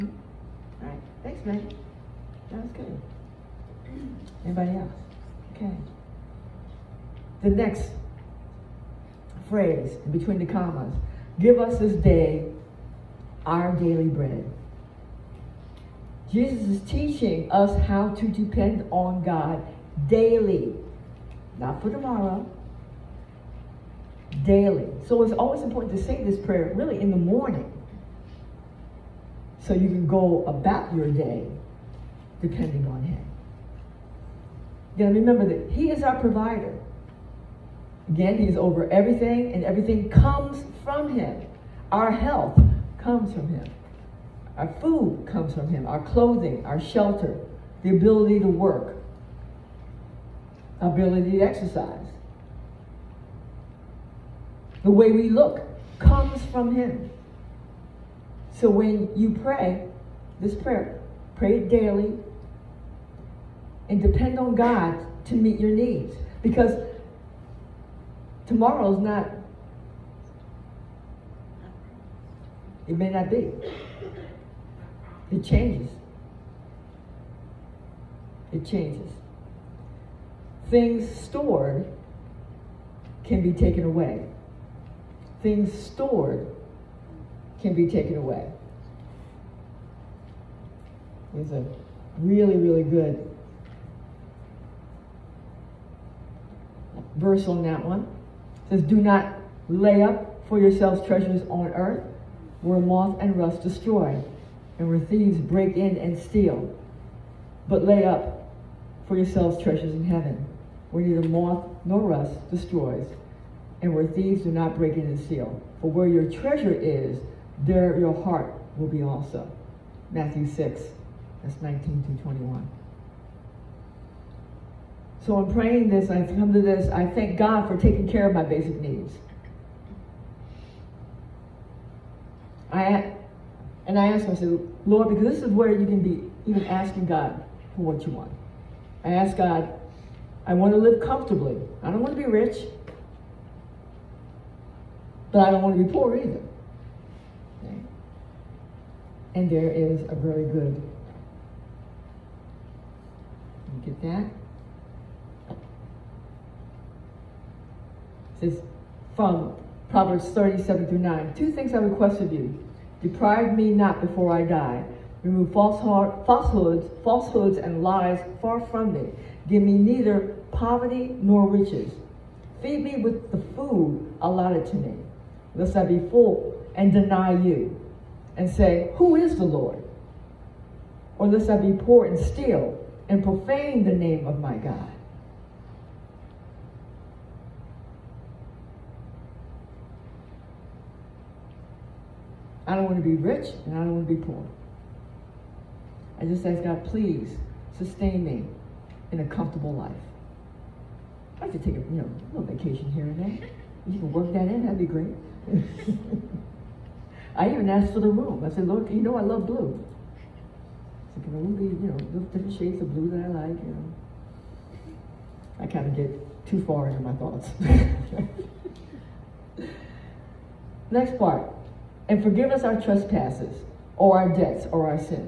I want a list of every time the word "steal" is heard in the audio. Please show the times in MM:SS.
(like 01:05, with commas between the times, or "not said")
01:46, 01:55, 03:02.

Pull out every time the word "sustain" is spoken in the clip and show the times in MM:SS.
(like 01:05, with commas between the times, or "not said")
03:17.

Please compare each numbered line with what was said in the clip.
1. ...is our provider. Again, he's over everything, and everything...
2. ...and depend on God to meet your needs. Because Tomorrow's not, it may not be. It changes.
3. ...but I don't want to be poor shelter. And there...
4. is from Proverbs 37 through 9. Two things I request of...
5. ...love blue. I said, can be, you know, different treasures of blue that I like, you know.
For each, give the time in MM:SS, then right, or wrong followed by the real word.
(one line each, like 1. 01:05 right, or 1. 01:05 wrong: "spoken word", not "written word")
1. 00:35 right
2. 01:03 right
3. 02:25 wrong: "either", not "shelter"
4. 02:38 right
5. 03:29 wrong: "shades", not "treasures".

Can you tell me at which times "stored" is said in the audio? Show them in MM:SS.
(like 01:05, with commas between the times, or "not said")
01:21, 01:25.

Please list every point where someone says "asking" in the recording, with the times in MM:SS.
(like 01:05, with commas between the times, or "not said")
02:16.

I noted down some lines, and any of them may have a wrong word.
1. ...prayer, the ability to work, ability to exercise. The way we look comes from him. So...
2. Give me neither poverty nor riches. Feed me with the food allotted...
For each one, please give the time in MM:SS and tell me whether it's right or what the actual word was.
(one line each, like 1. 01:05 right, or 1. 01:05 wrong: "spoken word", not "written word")
1. 00:46 wrong: "shelter", not "prayer"
2. 02:49 right.